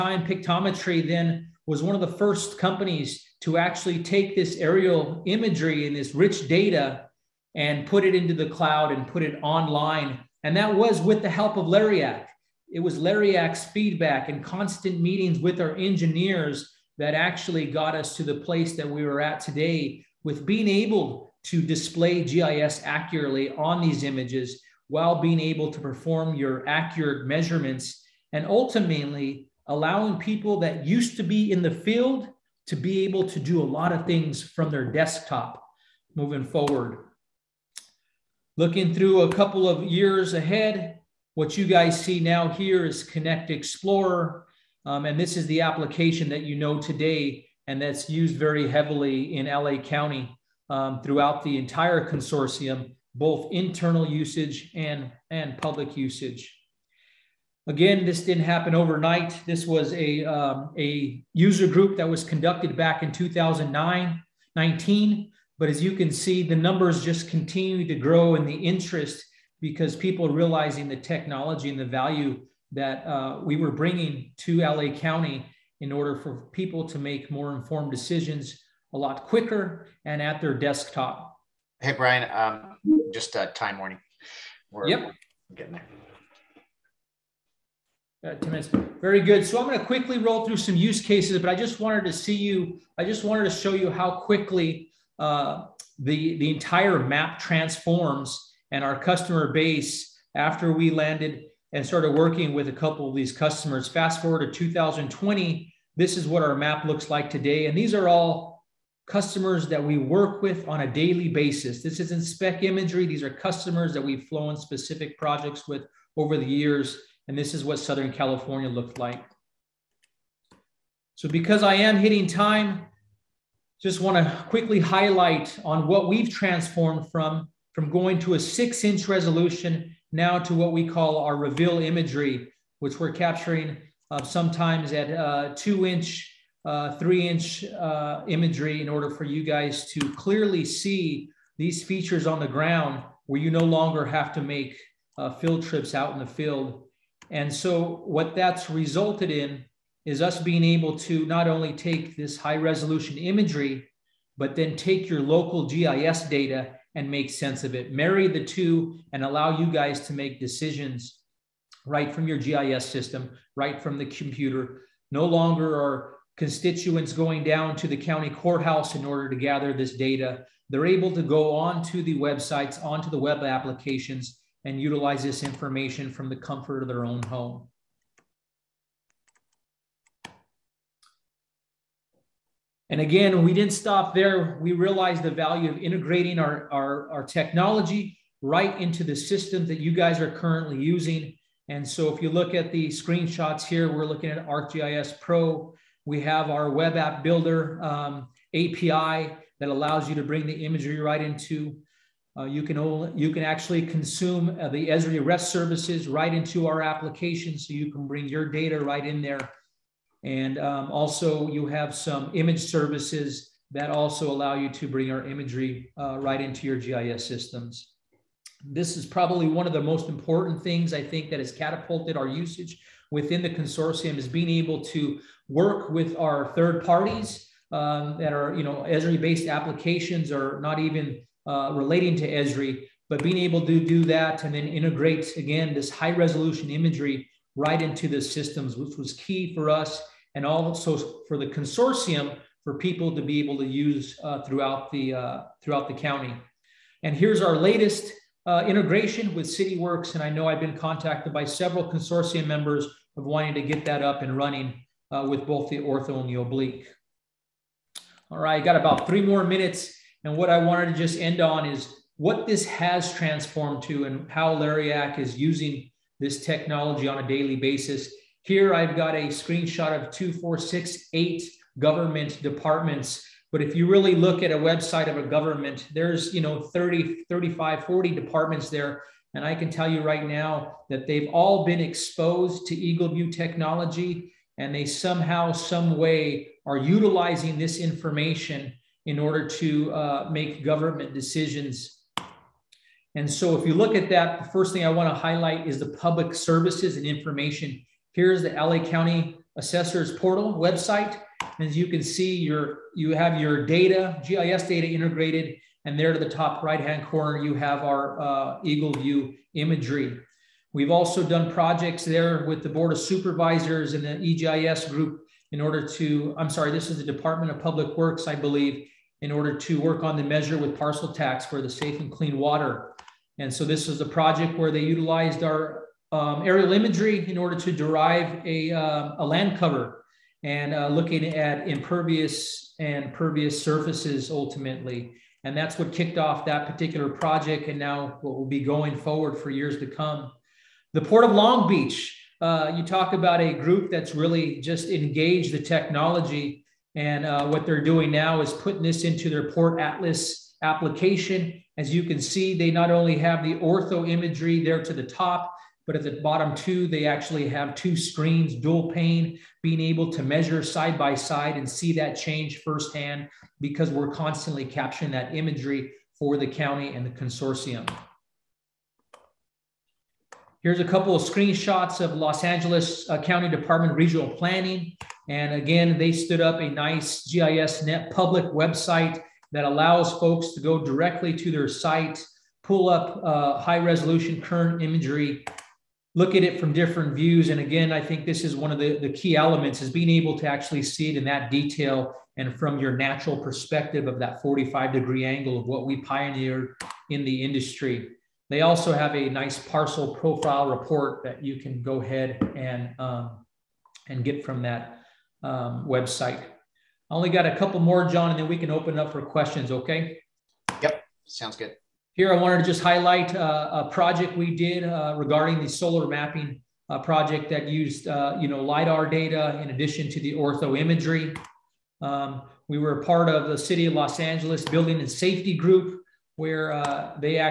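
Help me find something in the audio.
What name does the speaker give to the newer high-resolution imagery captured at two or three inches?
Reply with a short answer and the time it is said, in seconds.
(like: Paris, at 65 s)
reveal imagery, at 131 s.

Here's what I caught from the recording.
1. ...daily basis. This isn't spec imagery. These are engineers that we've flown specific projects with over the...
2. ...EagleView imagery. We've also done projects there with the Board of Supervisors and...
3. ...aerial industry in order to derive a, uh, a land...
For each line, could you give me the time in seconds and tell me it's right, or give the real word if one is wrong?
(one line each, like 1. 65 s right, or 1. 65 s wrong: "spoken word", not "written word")
1. 110 s wrong: "customers", not "engineers"
2. 308 s right
3. 326 s wrong: "imagery", not "industry".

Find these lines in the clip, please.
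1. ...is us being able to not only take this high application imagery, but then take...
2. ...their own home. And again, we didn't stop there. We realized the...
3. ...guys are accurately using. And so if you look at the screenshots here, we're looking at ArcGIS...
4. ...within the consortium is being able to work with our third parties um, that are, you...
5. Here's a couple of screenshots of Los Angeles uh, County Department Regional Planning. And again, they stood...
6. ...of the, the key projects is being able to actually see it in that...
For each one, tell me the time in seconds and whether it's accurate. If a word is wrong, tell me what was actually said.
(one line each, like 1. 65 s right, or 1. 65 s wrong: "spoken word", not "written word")
1. 150 s wrong: "resolution", not "application"
2. 176 s right
3. 189 s wrong: "currently", not "accurately"
4. 223 s right
5. 370 s right
6. 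388 s wrong: "elements", not "projects".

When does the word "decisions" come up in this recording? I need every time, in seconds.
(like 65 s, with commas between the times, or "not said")
77 s, 160 s, 291 s.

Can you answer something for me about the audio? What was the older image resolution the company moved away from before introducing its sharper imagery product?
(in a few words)
six inch.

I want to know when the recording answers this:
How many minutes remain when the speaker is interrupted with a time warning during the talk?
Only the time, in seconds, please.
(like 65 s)
88 s.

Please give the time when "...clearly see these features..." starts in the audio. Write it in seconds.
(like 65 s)
140 s.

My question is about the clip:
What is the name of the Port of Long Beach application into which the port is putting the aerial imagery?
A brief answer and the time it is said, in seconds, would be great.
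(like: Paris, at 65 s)
Port Atlas, at 349 s.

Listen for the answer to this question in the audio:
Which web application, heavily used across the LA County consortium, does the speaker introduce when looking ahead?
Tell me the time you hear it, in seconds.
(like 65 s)
43 s.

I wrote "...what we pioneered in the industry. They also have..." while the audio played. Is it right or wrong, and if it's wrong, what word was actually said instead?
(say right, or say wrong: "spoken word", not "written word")
right.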